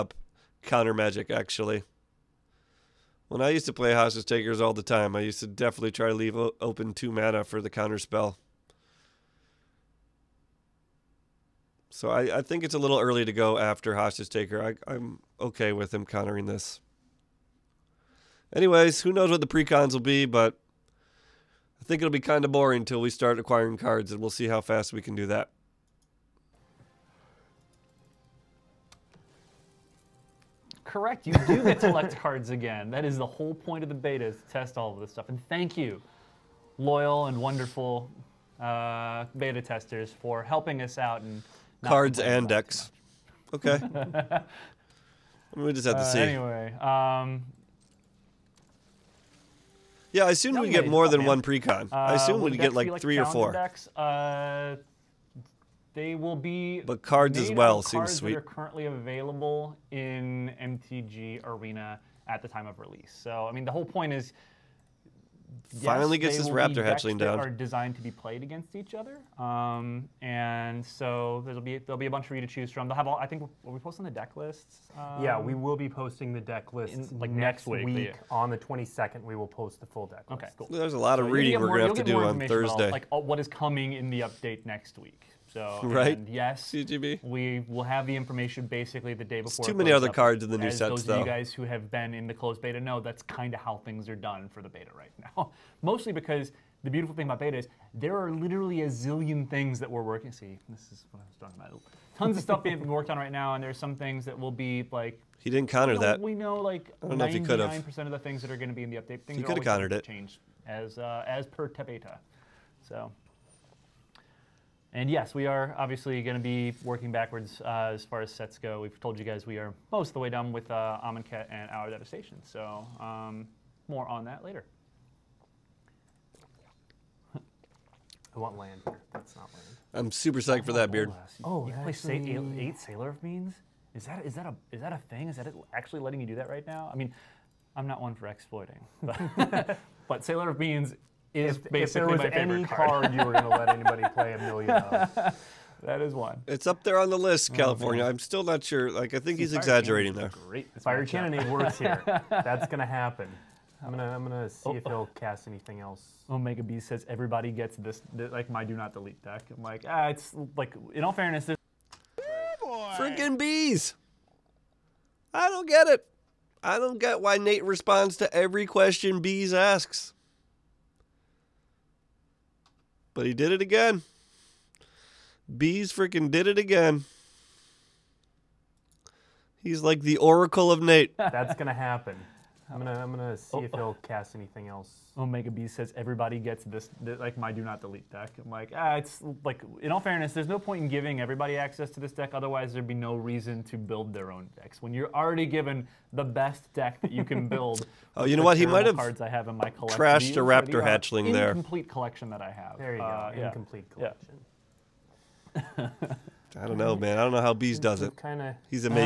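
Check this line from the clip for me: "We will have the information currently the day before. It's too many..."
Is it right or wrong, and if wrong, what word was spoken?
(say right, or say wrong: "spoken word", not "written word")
wrong: "basically", not "currently".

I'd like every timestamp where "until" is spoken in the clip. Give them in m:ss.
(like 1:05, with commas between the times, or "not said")
0:22.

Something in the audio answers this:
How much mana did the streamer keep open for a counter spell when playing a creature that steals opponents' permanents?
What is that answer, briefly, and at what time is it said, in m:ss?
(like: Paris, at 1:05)
2, at 0:06.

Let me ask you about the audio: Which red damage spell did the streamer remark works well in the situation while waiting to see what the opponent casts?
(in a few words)
Fiery Cannonade.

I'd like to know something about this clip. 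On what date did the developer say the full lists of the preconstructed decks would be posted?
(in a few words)
the 22nd.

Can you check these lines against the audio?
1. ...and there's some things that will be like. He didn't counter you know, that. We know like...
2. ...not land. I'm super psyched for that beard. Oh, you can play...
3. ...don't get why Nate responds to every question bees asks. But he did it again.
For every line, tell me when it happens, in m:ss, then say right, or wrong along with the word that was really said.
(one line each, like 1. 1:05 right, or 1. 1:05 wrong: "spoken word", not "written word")
1. 1:43 right
2. 2:09 right
3. 2:46 right.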